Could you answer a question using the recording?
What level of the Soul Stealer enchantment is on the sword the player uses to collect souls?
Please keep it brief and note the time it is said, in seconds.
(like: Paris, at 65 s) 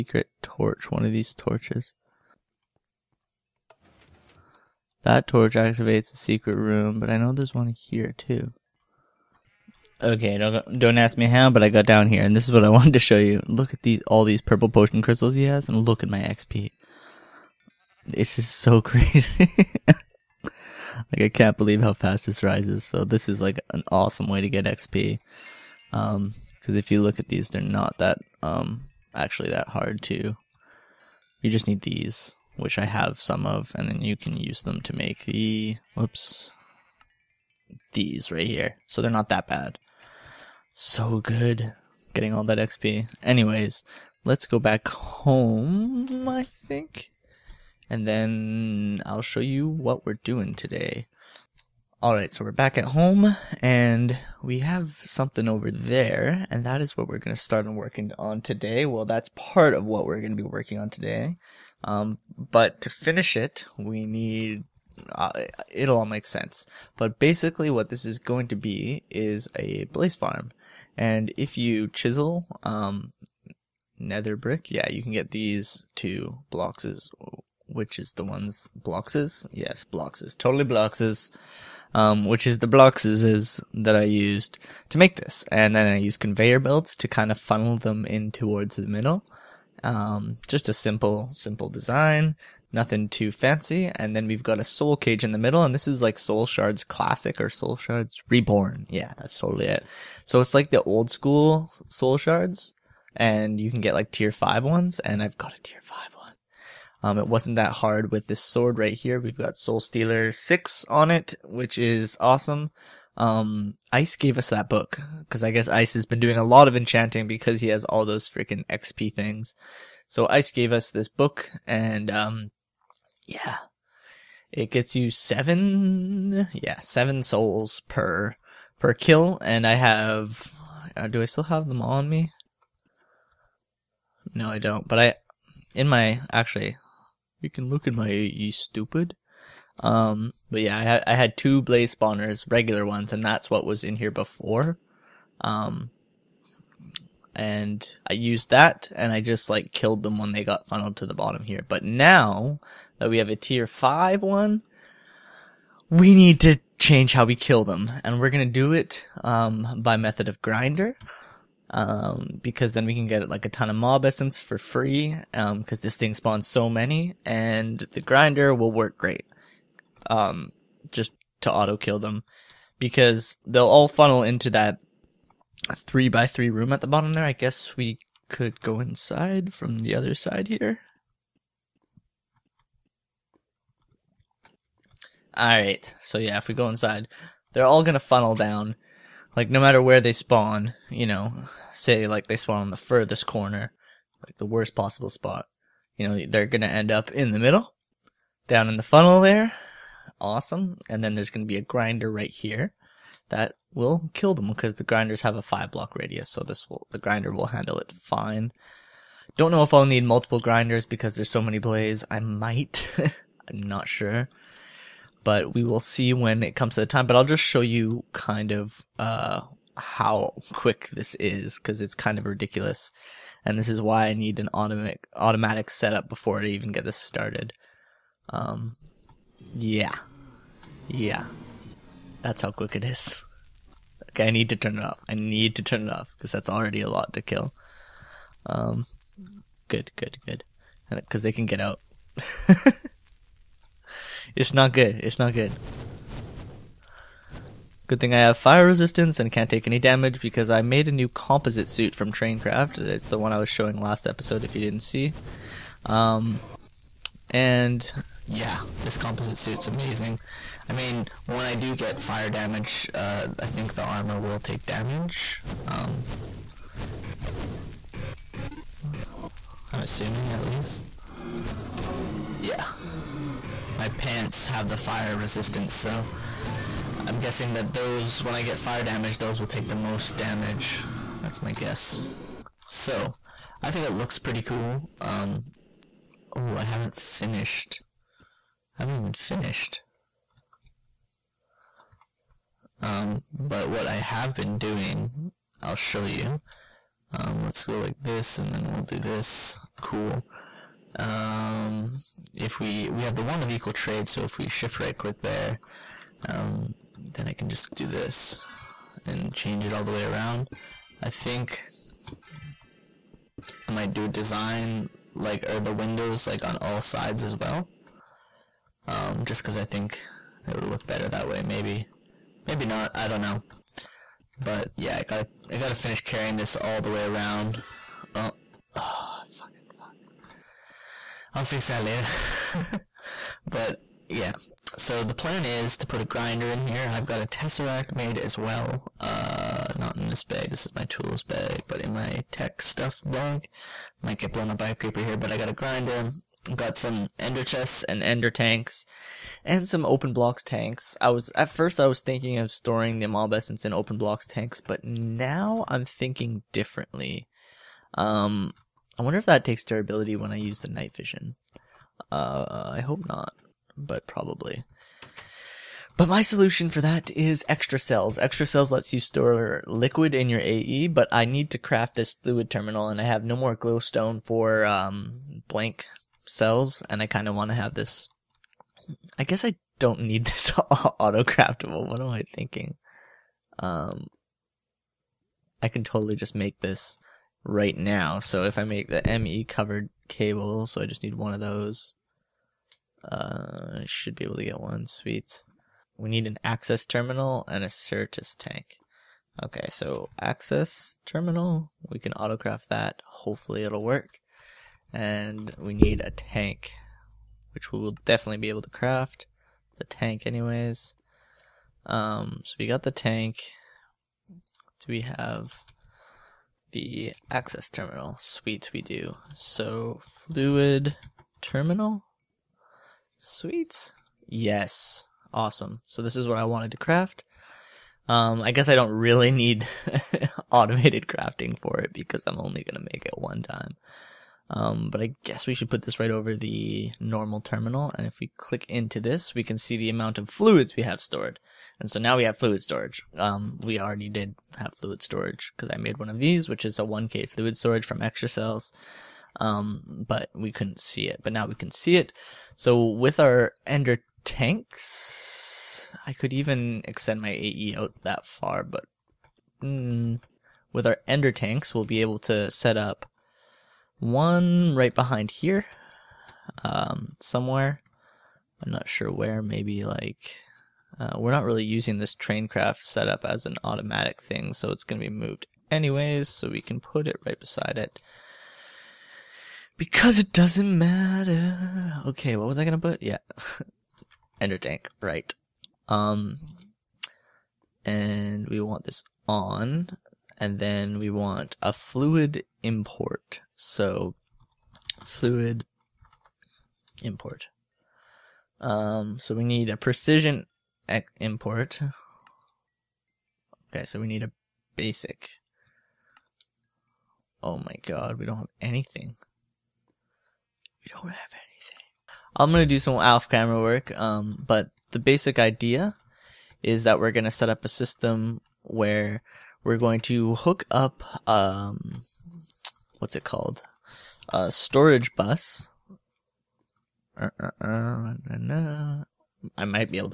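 6, at 109 s.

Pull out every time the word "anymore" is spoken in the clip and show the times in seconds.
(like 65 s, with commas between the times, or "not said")
not said.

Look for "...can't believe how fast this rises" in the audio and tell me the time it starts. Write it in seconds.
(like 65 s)
21 s.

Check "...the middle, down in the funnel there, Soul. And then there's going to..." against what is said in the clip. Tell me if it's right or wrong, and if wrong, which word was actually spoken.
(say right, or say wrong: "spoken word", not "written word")
wrong: "Awesome", not "Soul".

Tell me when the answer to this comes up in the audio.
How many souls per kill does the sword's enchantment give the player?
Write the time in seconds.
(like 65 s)
126 s.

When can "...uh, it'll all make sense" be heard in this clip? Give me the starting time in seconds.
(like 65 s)
65 s.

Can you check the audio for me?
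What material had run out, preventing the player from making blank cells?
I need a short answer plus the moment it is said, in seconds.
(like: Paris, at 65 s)
glowstone, at 373 s.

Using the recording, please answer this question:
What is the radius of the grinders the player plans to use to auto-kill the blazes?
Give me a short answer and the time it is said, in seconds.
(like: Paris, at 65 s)
5 blocks, at 205 s.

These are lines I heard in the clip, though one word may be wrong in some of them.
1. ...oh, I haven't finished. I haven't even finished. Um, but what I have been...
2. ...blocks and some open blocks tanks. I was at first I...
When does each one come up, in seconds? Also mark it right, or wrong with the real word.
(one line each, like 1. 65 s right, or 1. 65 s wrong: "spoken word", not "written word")
1. 286 s right
2. 348 s wrong: "tanks", not "blocks".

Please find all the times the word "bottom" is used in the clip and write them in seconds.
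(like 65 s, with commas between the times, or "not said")
151 s, 176 s.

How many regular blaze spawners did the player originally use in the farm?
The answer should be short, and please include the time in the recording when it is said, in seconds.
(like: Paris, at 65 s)
2, at 141 s.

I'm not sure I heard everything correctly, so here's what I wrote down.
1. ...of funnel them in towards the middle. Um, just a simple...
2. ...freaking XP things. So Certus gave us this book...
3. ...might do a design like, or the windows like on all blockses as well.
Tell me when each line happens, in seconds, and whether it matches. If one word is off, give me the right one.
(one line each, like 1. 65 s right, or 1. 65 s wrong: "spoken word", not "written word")
1. 87 s right
2. 118 s wrong: "Ice", not "Certus"
3. 313 s wrong: "sides", not "blockses".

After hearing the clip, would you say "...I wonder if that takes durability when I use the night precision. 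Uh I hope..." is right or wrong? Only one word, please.
wrong.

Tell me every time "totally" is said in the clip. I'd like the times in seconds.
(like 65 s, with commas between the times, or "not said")
80 s, 99 s, 385 s.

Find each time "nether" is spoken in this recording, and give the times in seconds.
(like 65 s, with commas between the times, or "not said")
73 s.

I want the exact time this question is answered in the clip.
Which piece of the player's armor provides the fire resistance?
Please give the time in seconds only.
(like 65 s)
273 s.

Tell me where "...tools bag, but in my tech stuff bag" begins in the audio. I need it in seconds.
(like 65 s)
340 s.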